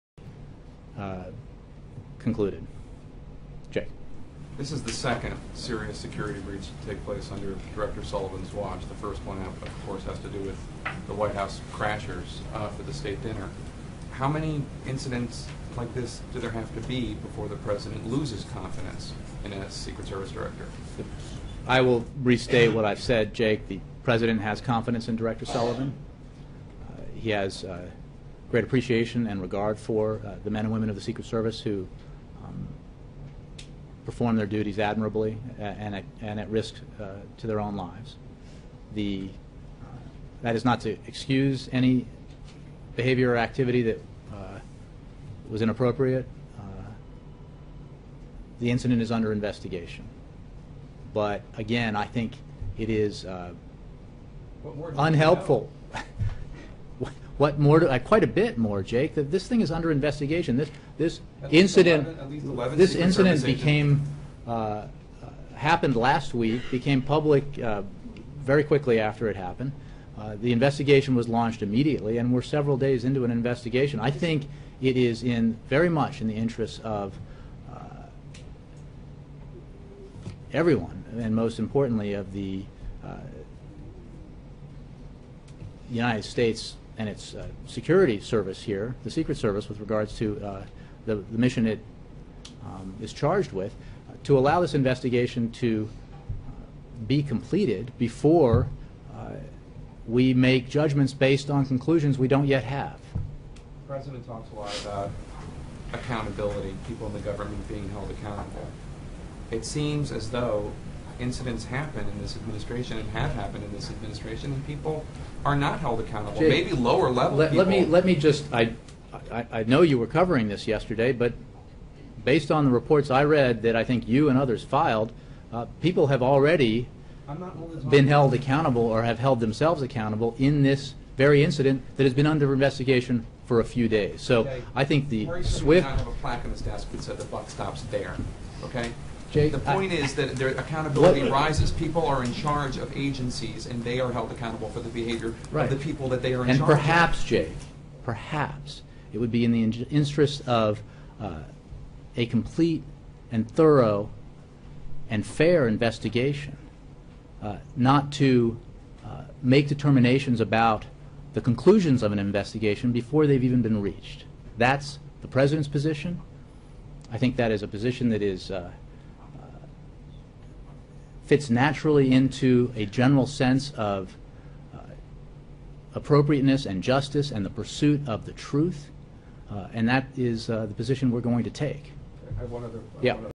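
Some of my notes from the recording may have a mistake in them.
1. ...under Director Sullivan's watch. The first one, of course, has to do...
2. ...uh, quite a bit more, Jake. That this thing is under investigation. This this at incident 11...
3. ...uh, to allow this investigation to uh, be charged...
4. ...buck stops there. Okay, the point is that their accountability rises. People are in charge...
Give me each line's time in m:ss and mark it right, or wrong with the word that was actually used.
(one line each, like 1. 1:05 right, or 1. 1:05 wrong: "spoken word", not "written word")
1. 0:07 right
2. 0:57 right
3. 1:34 wrong: "completed", not "charged"
4. 2:17 right.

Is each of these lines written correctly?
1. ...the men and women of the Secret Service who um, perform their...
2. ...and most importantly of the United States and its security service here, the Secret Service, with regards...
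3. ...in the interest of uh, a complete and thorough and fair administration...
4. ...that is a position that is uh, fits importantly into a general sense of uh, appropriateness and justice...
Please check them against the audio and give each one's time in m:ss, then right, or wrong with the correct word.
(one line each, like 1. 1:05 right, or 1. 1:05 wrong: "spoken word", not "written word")
1. 0:30 right
2. 1:21 right
3. 2:29 wrong: "investigation", not "administration"
4. 2:47 wrong: "naturally", not "importantly".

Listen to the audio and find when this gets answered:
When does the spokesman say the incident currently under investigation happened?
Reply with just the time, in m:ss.
1:05.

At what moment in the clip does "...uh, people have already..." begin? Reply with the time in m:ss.
2:05.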